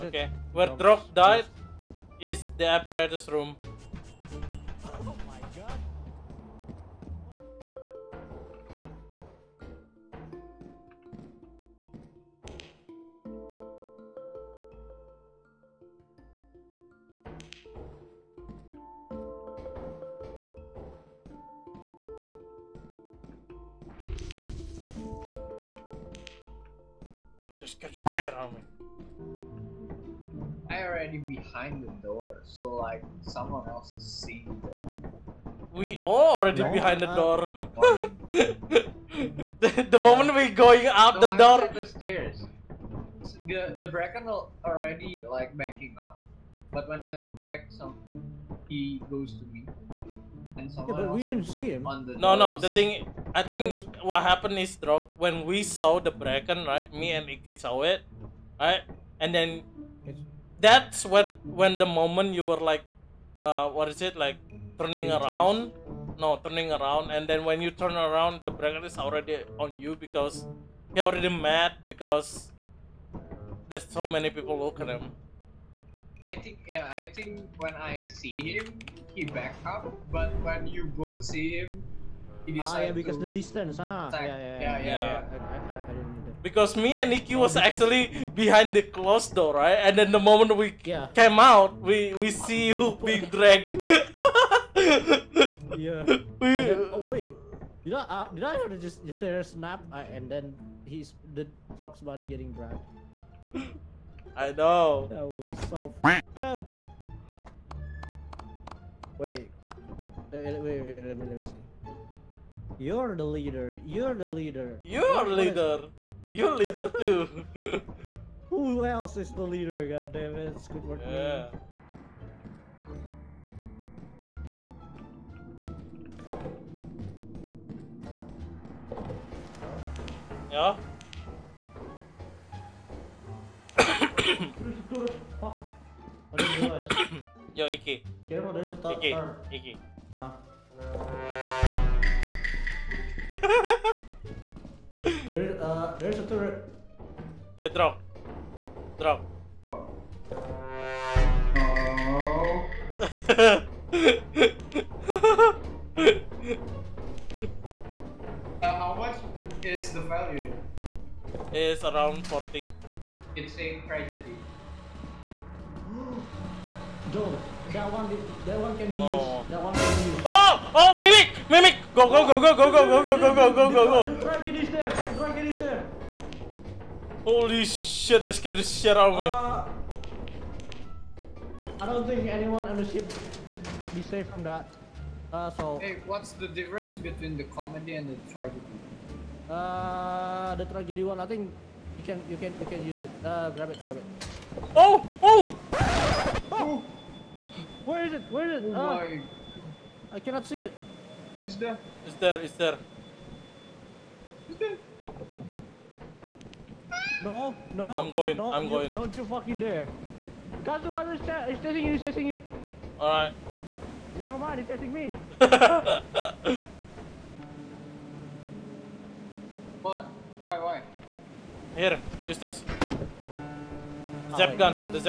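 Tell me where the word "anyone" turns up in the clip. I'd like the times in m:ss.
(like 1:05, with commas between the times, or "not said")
3:02.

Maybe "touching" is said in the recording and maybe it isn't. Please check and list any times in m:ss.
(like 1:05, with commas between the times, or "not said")
not said.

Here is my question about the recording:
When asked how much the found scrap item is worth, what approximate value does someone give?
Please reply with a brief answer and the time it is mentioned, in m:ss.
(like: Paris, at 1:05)
40, at 2:42.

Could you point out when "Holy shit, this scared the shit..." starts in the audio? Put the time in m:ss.
2:57.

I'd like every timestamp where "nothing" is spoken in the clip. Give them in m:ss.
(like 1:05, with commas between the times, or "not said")
not said.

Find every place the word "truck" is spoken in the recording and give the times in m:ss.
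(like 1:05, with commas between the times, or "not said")
1:41.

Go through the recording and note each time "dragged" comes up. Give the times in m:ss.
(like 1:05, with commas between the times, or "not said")
1:33, 1:42.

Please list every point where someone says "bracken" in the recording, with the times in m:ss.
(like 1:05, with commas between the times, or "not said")
0:43, 0:56, 1:08.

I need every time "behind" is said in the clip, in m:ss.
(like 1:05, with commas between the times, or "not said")
0:31, 0:36, 1:28.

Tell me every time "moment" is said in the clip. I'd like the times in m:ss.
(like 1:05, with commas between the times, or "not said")
0:39, 1:01, 1:30.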